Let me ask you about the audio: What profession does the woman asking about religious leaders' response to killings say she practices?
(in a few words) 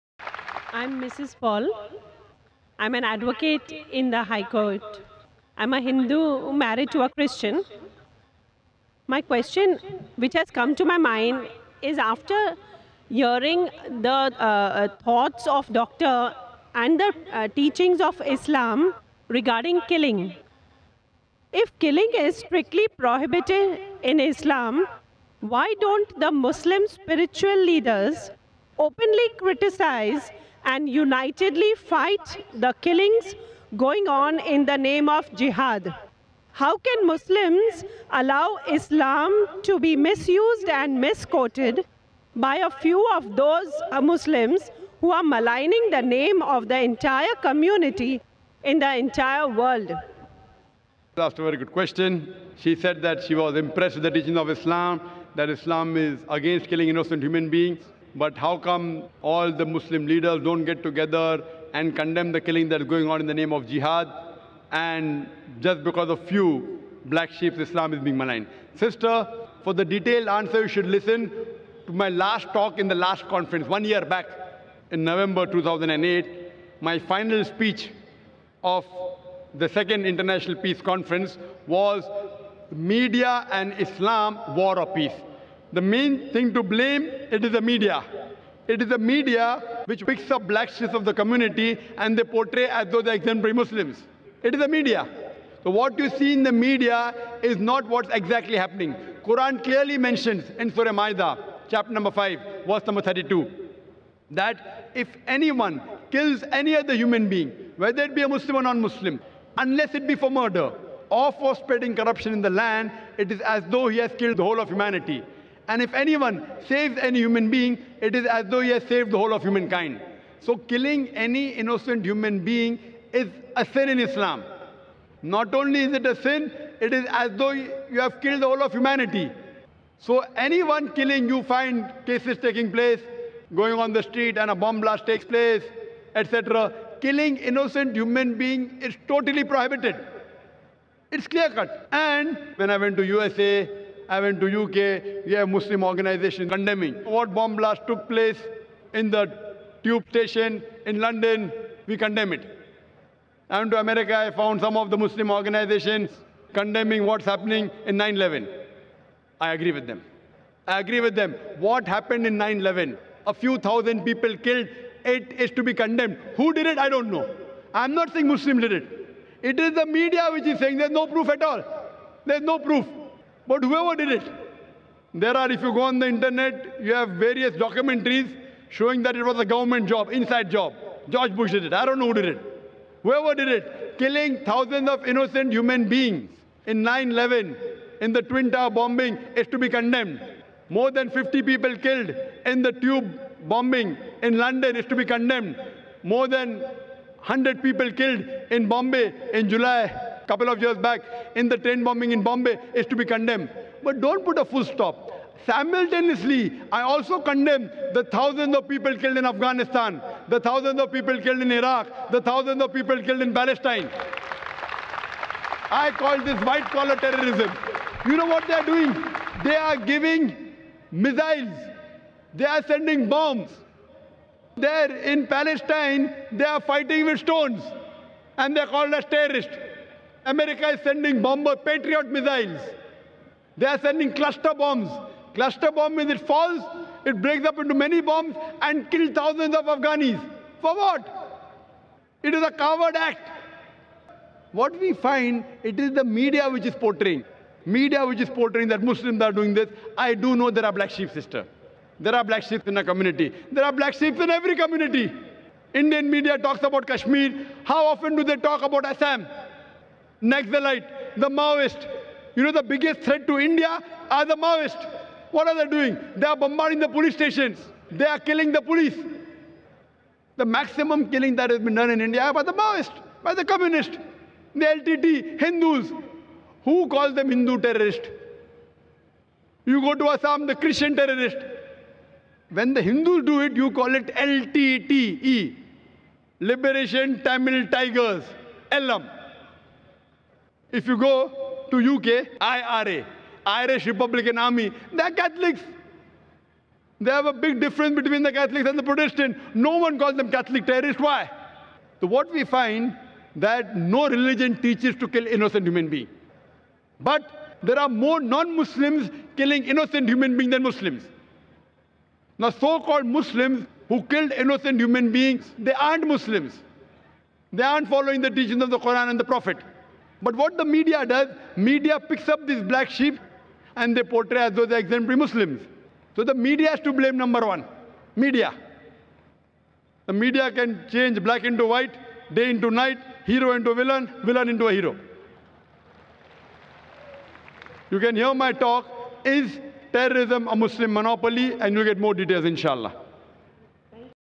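Advocate in the High Court.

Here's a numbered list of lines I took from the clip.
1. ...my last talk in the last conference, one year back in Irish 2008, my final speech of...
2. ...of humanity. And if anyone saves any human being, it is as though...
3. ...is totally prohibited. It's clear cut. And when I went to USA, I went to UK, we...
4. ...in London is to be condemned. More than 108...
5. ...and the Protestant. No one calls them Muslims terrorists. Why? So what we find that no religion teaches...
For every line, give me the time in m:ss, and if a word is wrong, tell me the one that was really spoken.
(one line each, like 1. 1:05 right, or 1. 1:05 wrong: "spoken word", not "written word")
1. 1:11 wrong: "November", not "Irish"
2. 1:54 right
3. 2:18 right
4. 3:14 wrong: "100", not "108"
5. 4:58 wrong: "Catholic", not "Muslims".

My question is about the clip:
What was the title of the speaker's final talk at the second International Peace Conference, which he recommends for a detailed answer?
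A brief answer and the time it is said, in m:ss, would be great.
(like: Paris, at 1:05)
Media and Islam, War or Peace, at 1:22.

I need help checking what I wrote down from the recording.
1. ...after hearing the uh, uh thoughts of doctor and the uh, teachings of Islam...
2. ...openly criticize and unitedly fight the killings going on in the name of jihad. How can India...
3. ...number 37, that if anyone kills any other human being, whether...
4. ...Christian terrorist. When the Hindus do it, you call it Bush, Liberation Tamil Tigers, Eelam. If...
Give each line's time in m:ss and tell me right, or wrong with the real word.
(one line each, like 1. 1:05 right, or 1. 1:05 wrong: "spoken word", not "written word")
1. 0:11 right
2. 0:28 wrong: "Muslims", not "India"
3. 1:42 wrong: "32", not "37"
4. 4:40 wrong: "LTTE", not "Bush".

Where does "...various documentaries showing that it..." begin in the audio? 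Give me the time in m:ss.
2:57.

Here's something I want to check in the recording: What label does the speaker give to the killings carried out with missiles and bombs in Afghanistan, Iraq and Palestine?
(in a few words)
White collar terrorism.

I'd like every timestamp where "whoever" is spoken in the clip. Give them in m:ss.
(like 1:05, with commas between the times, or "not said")
2:53, 3:03.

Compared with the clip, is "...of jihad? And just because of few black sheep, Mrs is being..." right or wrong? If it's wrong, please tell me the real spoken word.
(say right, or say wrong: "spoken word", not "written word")
wrong: "Islam", not "Mrs".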